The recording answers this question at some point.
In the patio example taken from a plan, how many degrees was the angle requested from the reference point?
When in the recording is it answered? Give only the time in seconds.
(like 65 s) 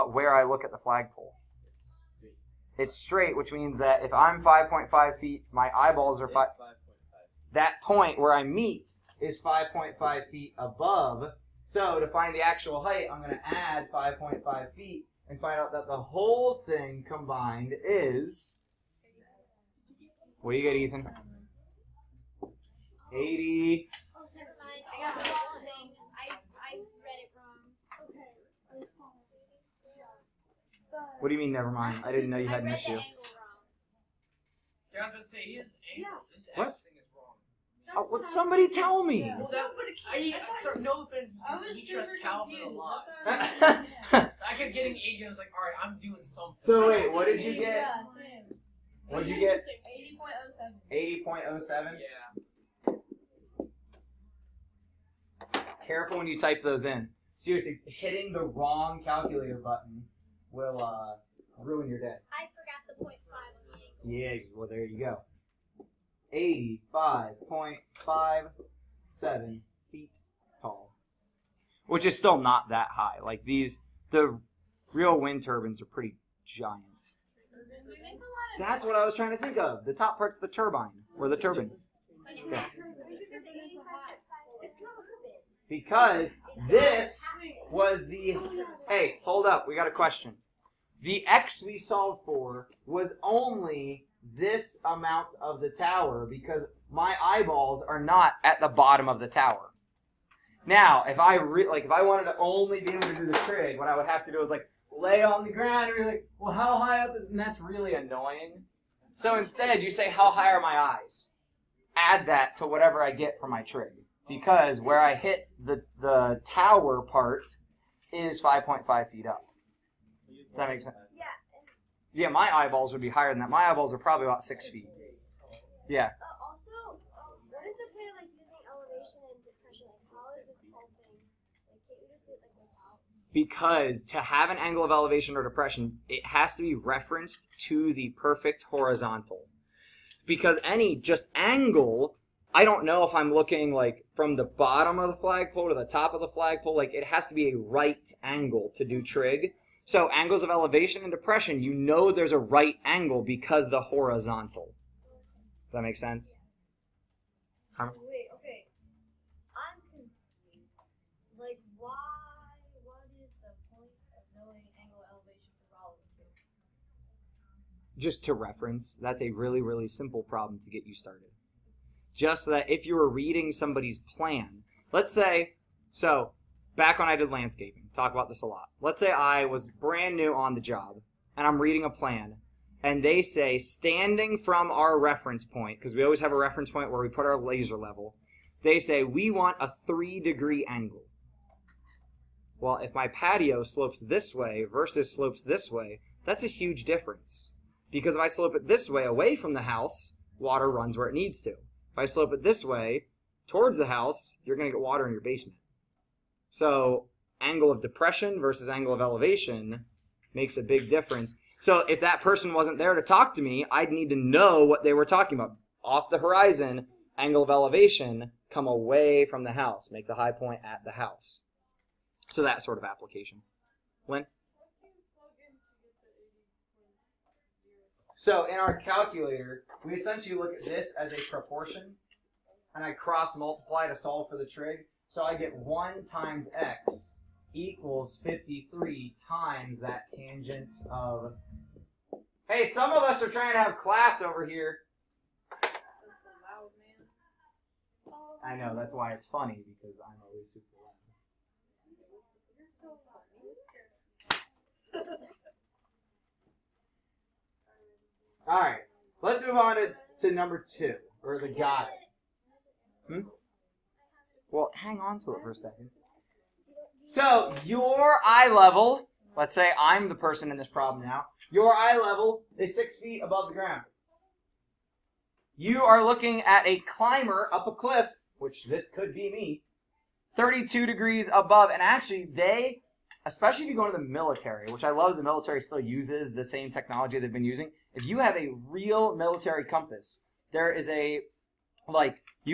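189 s.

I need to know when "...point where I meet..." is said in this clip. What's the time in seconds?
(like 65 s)
7 s.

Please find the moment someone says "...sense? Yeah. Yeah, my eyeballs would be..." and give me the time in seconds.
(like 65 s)
120 s.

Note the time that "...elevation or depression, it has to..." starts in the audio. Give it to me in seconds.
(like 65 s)
134 s.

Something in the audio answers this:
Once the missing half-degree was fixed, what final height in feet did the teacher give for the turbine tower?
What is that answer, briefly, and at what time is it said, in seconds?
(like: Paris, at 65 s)
85.57 feet, at 68 s.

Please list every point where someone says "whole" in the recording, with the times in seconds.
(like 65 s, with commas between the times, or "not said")
16 s, 130 s.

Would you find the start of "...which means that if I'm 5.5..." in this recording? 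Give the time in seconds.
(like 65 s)
3 s.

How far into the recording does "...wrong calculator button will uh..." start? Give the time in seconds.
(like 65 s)
58 s.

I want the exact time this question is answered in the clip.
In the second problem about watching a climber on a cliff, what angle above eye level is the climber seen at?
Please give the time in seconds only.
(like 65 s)
280 s.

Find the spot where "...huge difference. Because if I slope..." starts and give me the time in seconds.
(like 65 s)
196 s.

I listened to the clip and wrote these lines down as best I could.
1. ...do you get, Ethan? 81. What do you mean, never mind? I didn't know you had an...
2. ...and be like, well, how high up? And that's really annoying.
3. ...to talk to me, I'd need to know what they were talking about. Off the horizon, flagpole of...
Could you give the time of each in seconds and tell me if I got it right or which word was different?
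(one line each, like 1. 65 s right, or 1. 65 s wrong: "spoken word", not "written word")
1. 20 s wrong: "80", not "81"
2. 105 s right
3. 212 s wrong: "angle", not "flagpole".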